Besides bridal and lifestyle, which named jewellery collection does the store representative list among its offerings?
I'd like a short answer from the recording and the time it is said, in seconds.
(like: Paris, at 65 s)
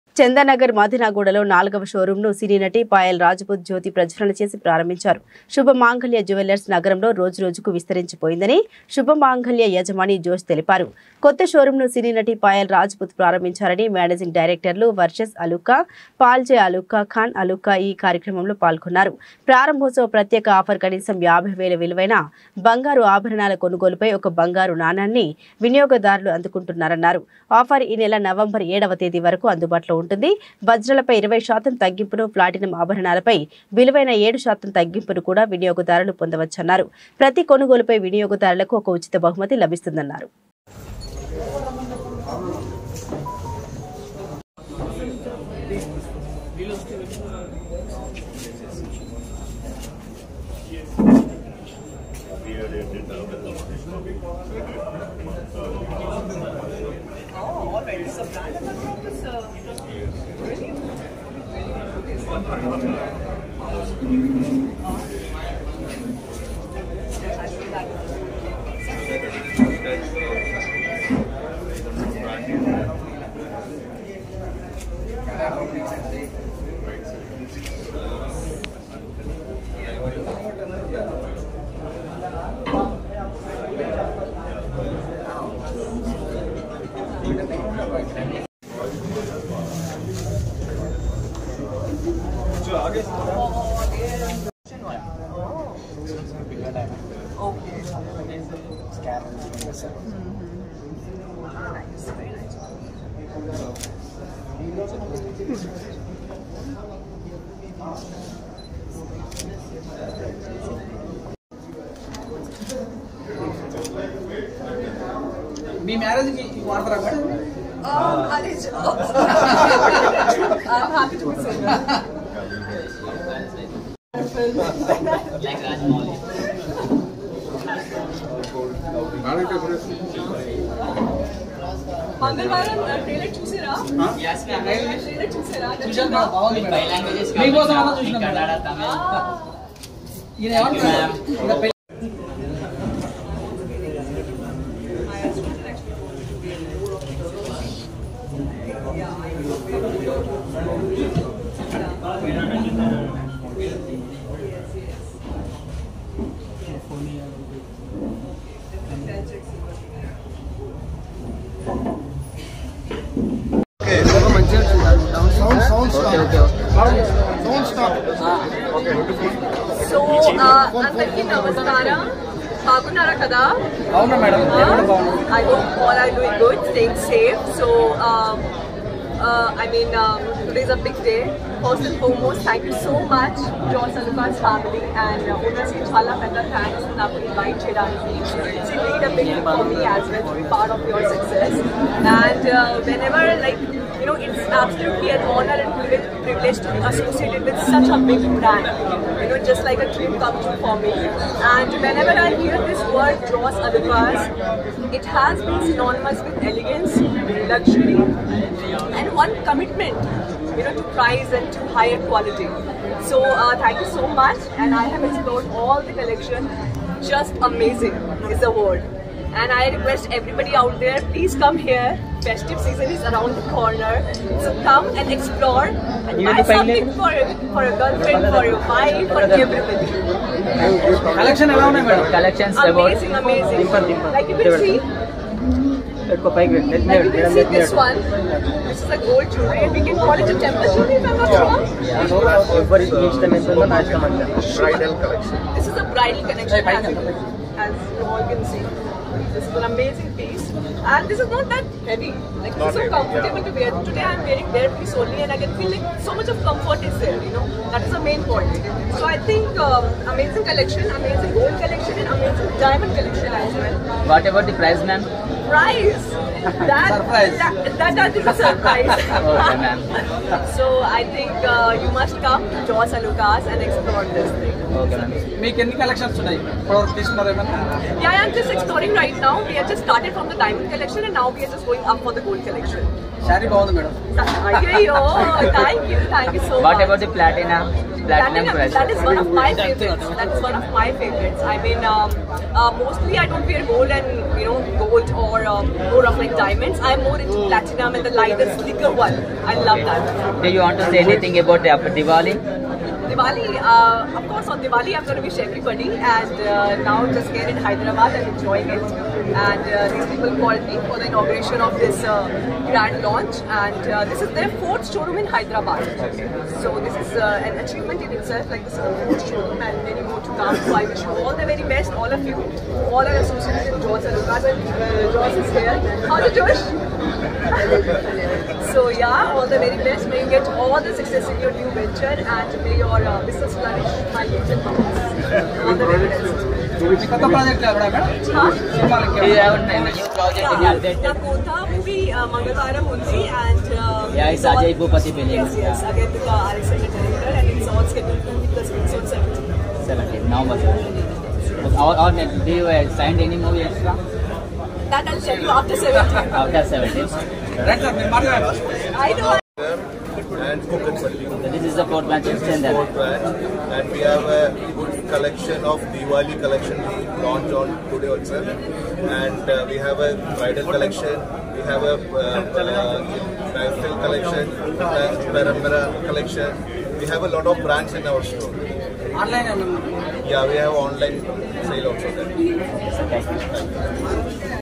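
Parampara, at 375 s.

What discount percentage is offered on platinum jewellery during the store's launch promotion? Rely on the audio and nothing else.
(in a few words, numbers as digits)
7%.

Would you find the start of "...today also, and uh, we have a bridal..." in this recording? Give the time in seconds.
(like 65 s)
367 s.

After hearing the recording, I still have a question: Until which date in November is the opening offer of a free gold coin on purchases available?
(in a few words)
November 7.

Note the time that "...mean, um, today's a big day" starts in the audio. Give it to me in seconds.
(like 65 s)
179 s.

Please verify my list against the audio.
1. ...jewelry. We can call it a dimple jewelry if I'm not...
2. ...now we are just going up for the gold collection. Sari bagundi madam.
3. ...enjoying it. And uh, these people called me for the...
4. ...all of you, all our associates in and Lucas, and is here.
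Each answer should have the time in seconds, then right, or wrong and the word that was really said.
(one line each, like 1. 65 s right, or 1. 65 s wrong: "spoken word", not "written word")
1. 239 s wrong: "temple", not "dimple"
2. 281 s right
3. 308 s right
4. 321 s right.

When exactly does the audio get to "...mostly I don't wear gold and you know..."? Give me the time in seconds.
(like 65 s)
292 s.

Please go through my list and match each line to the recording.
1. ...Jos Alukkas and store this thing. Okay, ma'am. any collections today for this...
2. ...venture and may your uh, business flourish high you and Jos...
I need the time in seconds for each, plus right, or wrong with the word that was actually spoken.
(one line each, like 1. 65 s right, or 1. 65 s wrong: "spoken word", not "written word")
1. 272 s wrong: "explore", not "store"
2. 331 s wrong: "All", not "Jos".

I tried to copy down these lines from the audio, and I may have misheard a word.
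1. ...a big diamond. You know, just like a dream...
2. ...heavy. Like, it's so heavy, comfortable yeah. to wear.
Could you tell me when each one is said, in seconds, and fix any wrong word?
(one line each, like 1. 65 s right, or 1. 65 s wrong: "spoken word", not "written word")
1. 197 s wrong: "brand", not "diamond"
2. 251 s right.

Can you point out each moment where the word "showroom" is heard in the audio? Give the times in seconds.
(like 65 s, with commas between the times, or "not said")
314 s, 319 s.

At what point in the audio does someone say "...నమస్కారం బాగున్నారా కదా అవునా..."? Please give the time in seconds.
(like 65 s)
171 s.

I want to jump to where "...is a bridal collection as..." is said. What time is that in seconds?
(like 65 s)
245 s.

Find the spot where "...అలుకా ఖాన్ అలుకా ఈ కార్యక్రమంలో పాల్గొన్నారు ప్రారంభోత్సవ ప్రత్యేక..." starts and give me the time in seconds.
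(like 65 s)
16 s.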